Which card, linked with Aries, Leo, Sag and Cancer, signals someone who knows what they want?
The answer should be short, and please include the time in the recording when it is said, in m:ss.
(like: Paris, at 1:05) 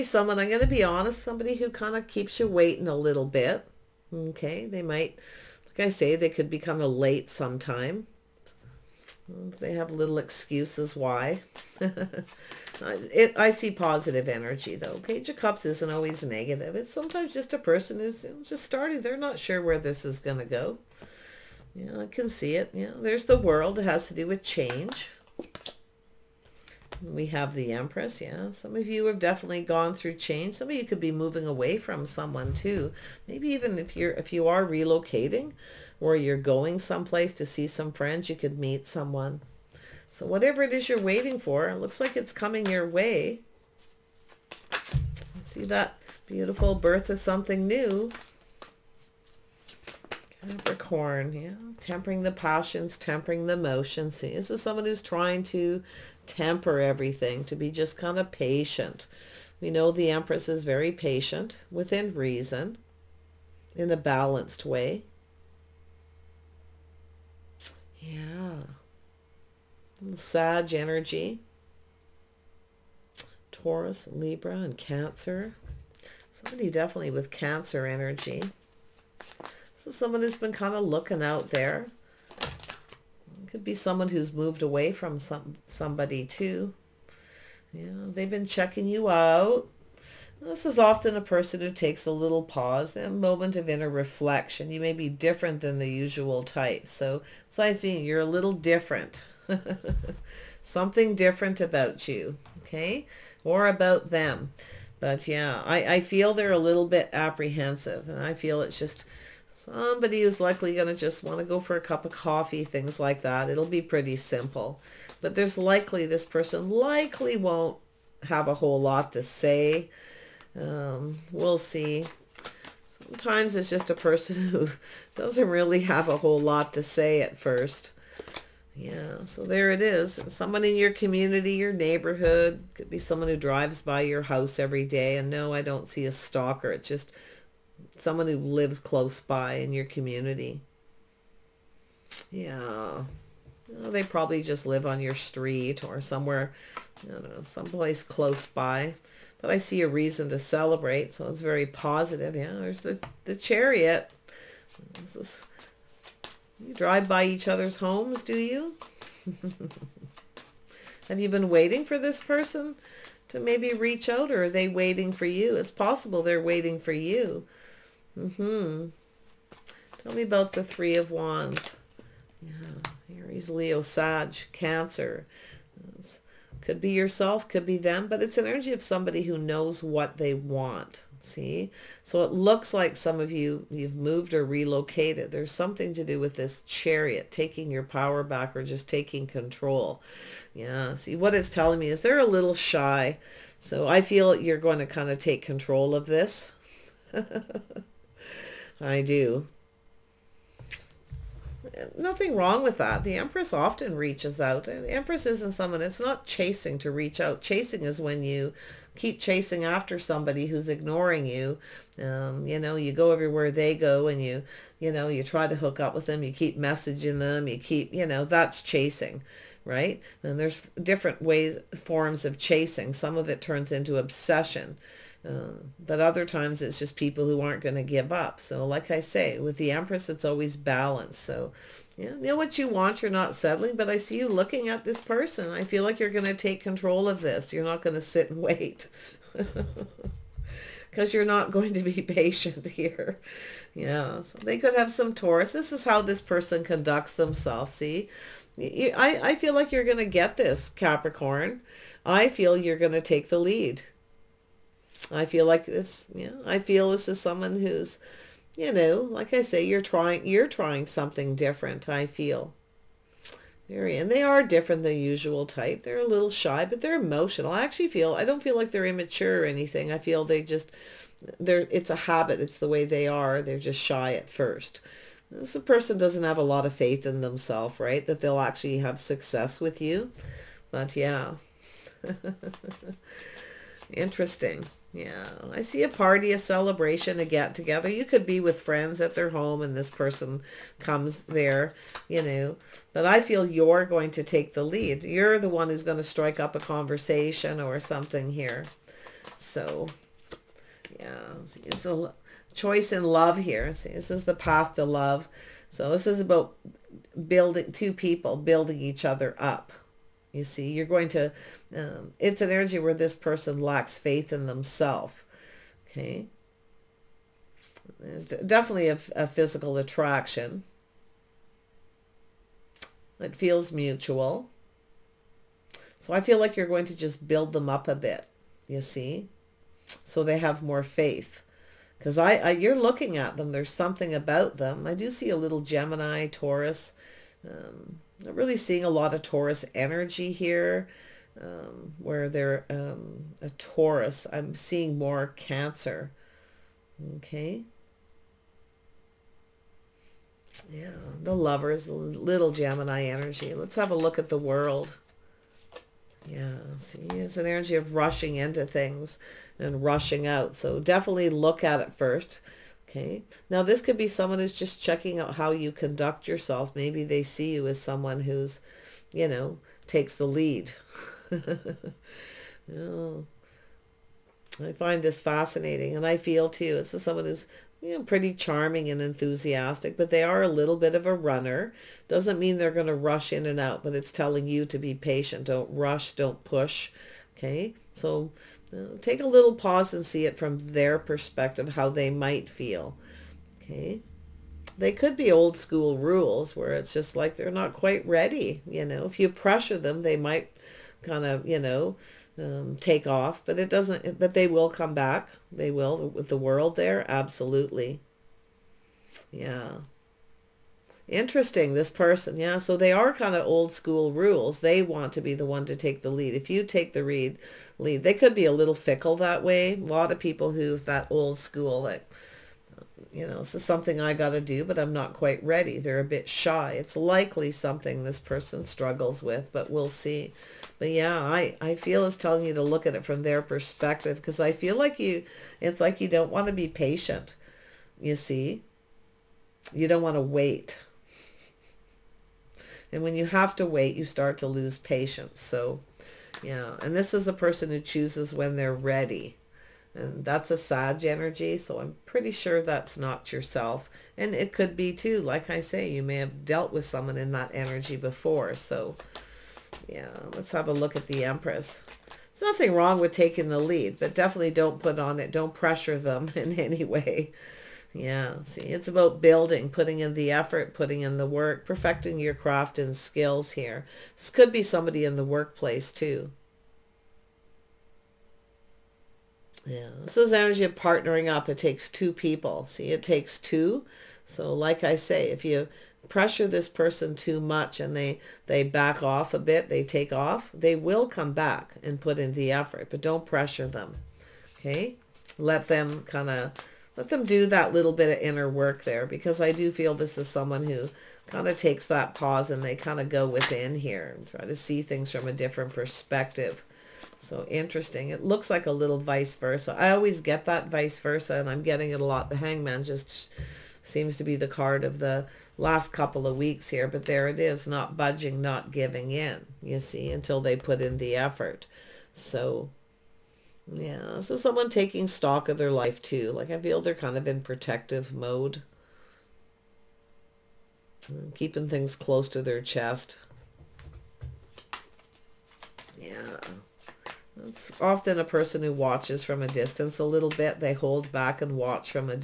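Three of Wands, at 2:50.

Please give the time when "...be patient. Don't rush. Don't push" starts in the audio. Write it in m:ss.
6:24.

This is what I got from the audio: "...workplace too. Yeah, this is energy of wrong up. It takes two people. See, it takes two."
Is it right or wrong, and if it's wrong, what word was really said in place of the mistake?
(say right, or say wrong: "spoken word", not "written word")
wrong: "partnering", not "wrong".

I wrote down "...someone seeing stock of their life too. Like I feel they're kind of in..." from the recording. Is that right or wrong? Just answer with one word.
wrong.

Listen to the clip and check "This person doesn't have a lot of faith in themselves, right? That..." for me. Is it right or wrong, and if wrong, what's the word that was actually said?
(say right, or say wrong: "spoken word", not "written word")
right.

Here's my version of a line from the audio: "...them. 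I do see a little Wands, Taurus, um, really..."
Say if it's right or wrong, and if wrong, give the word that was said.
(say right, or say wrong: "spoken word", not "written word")
wrong: "Gemini", not "Wands".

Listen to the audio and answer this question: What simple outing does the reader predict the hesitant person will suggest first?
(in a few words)
a cup of coffee.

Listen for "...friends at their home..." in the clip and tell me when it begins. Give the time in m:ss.
4:48.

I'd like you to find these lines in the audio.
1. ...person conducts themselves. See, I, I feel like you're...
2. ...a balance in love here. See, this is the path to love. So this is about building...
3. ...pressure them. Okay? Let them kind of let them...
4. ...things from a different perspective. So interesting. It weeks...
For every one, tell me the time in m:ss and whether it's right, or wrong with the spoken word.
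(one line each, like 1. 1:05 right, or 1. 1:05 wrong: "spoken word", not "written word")
1. 4:06 right
2. 5:01 wrong: "choice", not "balance"
3. 8:13 right
4. 8:24 wrong: "looks", not "weeks".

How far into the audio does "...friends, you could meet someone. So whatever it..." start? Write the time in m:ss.
0:37.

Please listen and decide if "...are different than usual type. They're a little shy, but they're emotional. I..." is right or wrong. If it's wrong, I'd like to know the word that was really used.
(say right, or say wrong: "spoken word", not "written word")
right.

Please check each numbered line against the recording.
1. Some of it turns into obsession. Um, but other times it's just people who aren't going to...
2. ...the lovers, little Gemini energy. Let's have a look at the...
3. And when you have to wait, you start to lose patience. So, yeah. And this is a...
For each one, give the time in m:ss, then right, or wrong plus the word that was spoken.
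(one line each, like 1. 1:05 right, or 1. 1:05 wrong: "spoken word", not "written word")
1. 3:42 right
2. 5:51 right
3. 7:22 right.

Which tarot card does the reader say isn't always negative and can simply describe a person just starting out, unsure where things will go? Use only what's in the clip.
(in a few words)
Page of Cups.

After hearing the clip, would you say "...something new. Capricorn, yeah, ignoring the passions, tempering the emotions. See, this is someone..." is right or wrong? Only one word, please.
wrong.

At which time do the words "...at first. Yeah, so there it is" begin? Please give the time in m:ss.
2:07.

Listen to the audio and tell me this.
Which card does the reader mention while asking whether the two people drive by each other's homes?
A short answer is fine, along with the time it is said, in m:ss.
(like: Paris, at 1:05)
The Chariot, at 2:33.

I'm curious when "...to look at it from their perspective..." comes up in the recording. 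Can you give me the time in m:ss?
7:12.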